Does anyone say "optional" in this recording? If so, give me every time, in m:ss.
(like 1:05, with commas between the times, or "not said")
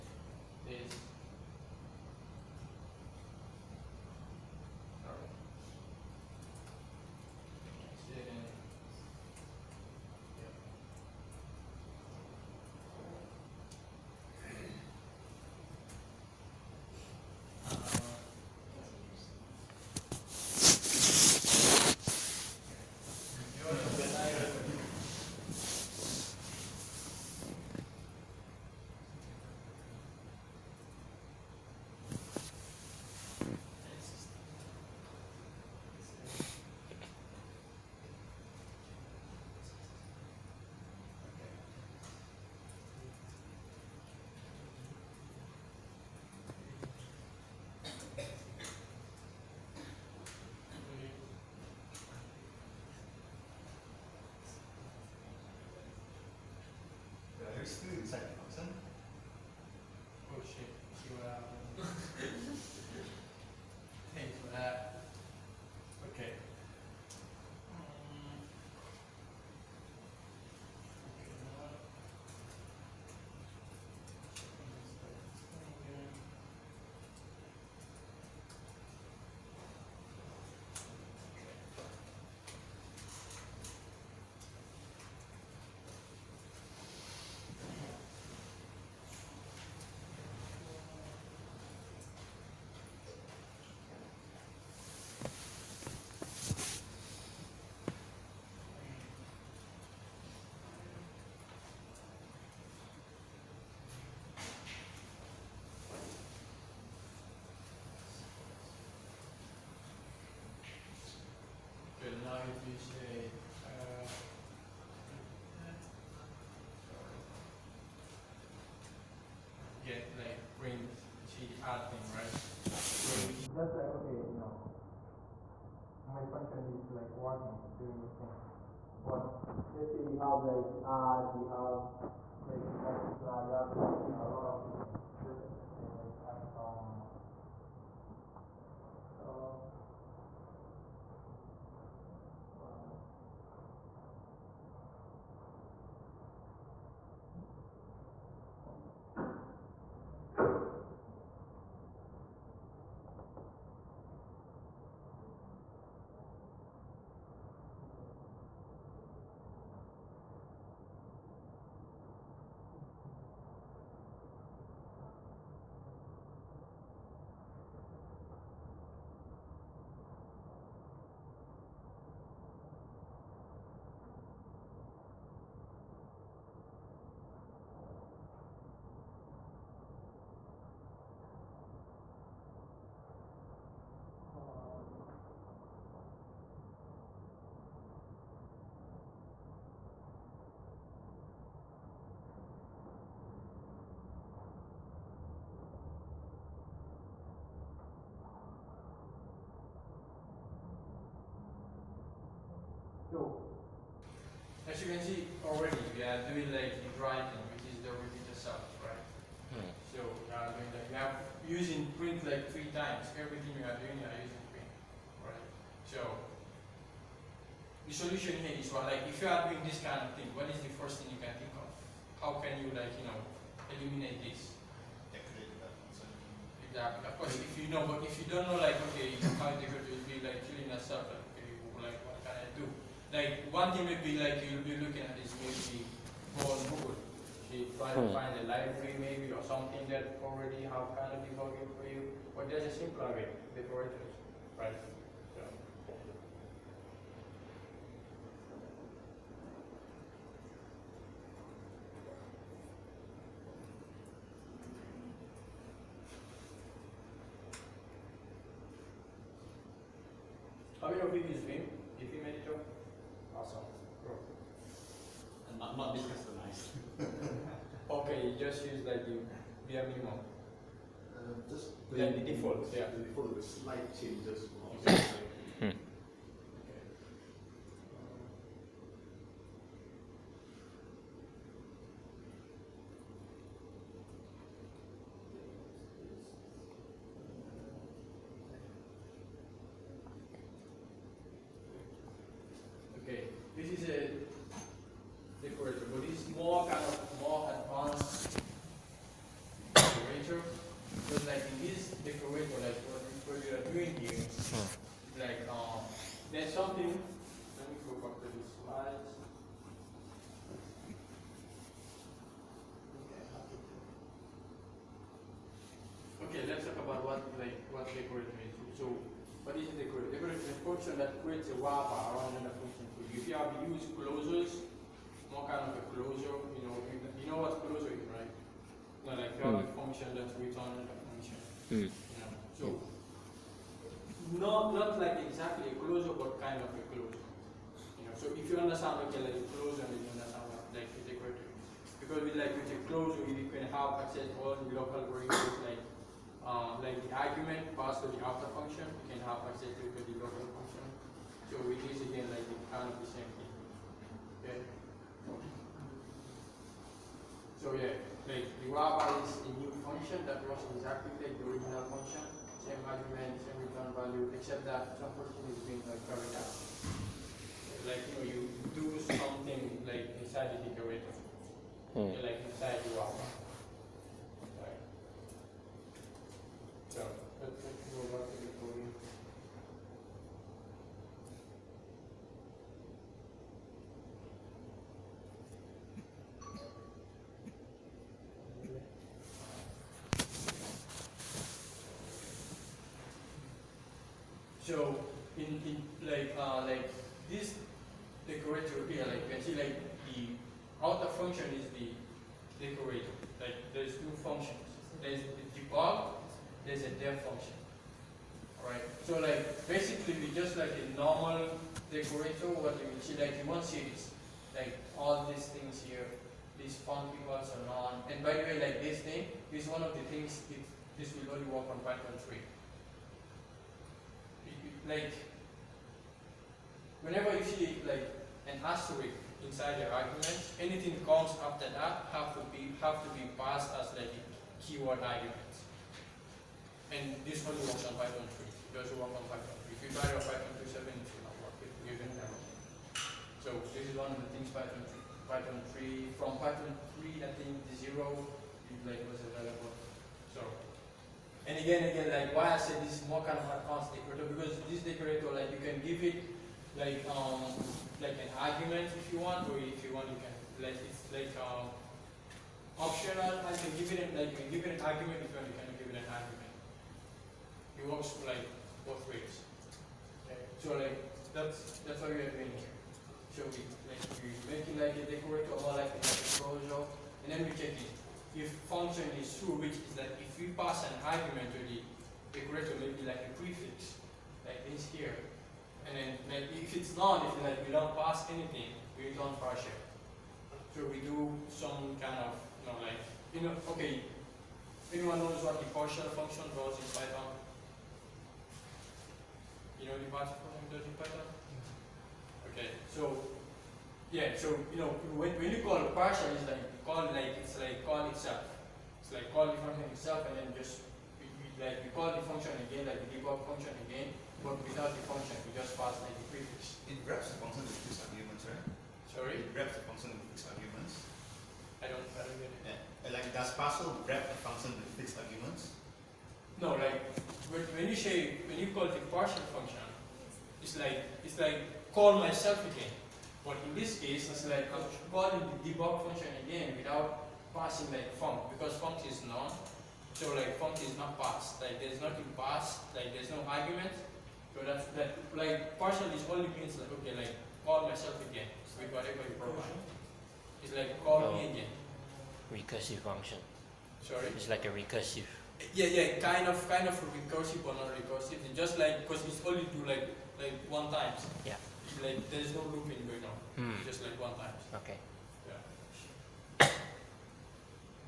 7:42.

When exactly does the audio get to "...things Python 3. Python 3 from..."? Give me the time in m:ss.
7:24.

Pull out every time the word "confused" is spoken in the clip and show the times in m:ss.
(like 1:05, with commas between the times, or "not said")
not said.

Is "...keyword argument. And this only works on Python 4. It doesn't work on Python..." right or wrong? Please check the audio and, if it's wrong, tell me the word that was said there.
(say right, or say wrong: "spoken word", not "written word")
wrong: "3", not "4".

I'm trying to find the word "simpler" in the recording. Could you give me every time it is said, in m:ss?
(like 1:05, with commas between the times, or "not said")
4:02.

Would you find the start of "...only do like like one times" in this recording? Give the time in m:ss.
9:19.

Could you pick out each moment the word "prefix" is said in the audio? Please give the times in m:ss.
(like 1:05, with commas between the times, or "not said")
8:03, 8:36.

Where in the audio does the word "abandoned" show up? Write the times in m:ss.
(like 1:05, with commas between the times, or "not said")
not said.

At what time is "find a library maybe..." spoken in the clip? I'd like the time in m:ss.
3:58.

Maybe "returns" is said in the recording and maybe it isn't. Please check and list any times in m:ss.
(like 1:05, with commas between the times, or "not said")
5:30, 6:03.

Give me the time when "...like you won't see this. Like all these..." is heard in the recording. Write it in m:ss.
6:53.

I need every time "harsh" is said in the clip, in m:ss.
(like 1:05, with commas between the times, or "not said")
not said.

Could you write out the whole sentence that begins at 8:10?
So we do some kind of you know like you know okay anyone knows what the partial function was in Python?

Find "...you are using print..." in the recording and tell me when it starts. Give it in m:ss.
3:33.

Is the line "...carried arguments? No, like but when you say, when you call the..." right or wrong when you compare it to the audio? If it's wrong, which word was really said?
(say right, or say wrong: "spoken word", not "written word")
wrong: "fixed", not "carried".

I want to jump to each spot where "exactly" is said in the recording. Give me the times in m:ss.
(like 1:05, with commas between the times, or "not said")
3:46, 5:35, 6:00.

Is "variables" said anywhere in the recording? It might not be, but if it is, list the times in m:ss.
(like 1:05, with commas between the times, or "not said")
5:45.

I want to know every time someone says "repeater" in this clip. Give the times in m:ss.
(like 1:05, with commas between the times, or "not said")
3:27.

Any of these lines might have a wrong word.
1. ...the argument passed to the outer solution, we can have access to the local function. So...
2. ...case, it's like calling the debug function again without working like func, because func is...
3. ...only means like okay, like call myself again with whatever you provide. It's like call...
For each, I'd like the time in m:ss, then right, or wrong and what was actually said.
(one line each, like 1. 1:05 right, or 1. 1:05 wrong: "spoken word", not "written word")
1. 5:47 wrong: "function", not "solution"
2. 8:53 wrong: "passing", not "working"
3. 9:06 right.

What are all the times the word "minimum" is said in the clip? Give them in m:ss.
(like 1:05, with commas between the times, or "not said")
4:29.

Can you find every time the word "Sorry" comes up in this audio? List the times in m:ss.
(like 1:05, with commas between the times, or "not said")
8:39, 9:14.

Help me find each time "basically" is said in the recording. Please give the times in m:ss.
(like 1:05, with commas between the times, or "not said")
6:49.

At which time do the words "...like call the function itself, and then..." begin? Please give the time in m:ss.
8:29.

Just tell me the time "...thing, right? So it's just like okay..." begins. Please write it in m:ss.
2:01.